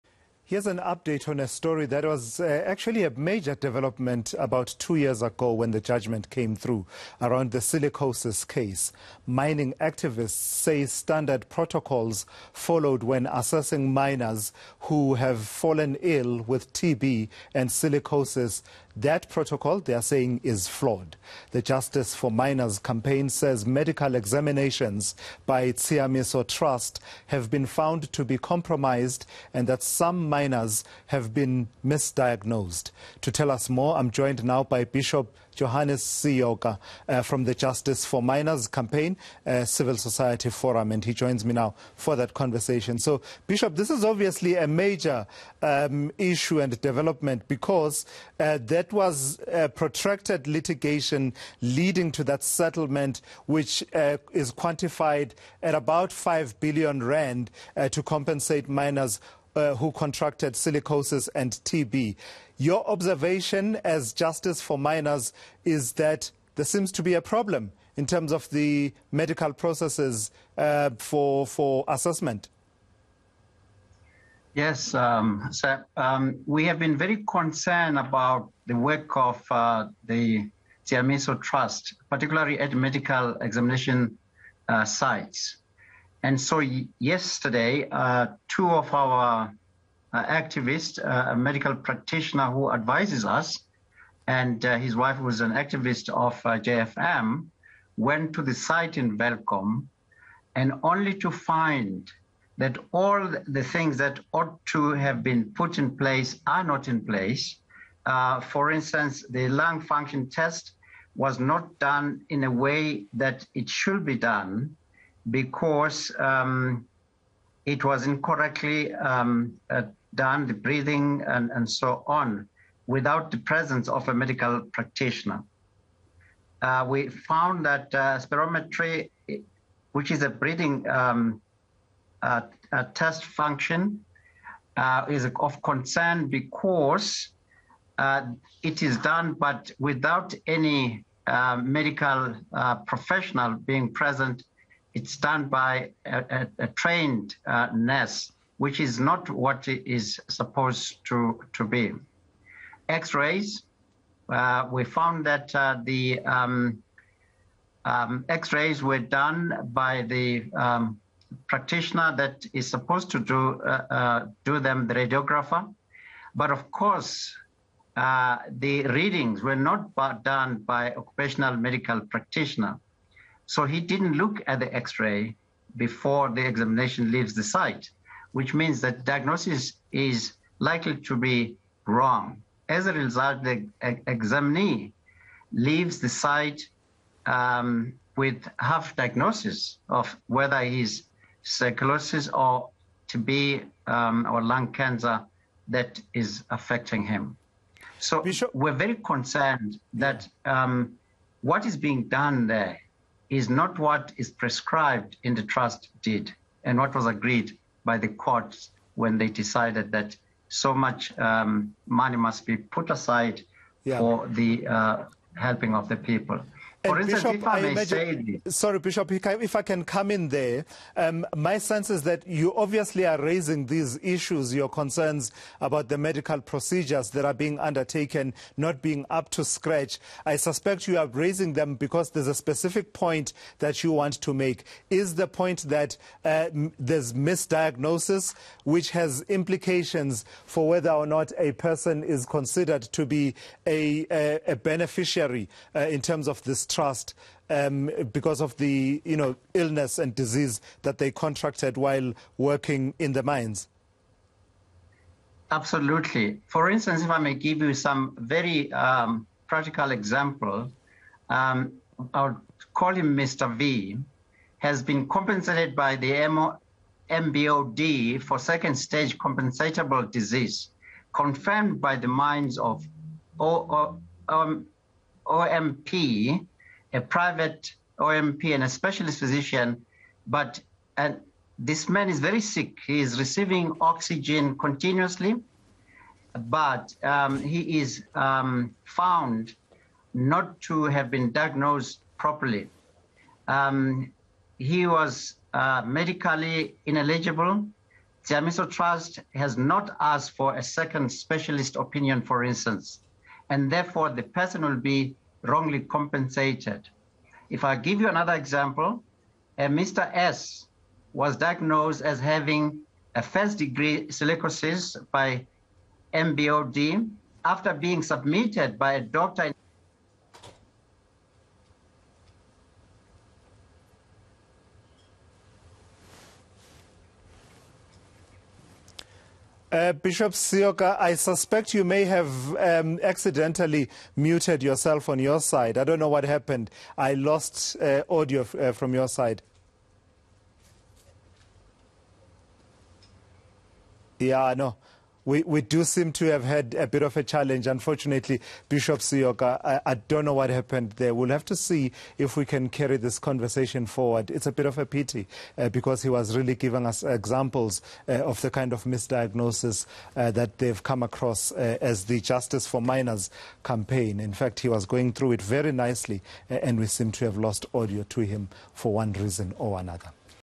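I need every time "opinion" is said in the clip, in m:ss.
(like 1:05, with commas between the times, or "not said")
5:01.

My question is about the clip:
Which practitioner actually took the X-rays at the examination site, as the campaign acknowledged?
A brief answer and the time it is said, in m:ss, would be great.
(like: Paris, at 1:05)
The radiographer, at 2:44.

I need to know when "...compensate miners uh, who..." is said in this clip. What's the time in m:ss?
0:58.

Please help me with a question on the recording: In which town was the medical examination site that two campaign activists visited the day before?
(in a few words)
Welkom.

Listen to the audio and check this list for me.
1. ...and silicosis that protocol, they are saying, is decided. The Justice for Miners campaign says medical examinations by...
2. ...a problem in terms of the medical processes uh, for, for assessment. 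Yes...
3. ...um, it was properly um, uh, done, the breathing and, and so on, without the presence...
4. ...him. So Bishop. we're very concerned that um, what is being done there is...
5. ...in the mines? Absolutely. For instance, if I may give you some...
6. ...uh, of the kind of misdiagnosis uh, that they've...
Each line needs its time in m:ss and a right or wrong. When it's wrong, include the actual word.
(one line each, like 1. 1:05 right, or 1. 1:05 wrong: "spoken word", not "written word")
1. 0:17 wrong: "flawed", not "decided"
2. 1:07 right
3. 1:56 wrong: "incorrectly", not "properly"
4. 3:17 right
5. 4:12 right
6. 5:58 right.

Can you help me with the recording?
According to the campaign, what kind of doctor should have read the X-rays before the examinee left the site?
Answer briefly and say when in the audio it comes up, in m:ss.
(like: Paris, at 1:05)
Occupational medical practitioner, at 2:50.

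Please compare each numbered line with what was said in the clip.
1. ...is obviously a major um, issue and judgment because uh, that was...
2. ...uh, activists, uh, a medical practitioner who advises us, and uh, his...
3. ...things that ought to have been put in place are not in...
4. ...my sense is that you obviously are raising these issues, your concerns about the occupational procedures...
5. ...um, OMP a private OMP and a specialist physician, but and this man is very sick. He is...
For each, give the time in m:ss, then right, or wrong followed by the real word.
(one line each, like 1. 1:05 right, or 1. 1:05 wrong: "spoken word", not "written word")
1. 0:43 wrong: "development", not "judgment"
2. 1:30 right
3. 1:43 right
4. 3:41 wrong: "medical", not "occupational"
5. 4:34 right.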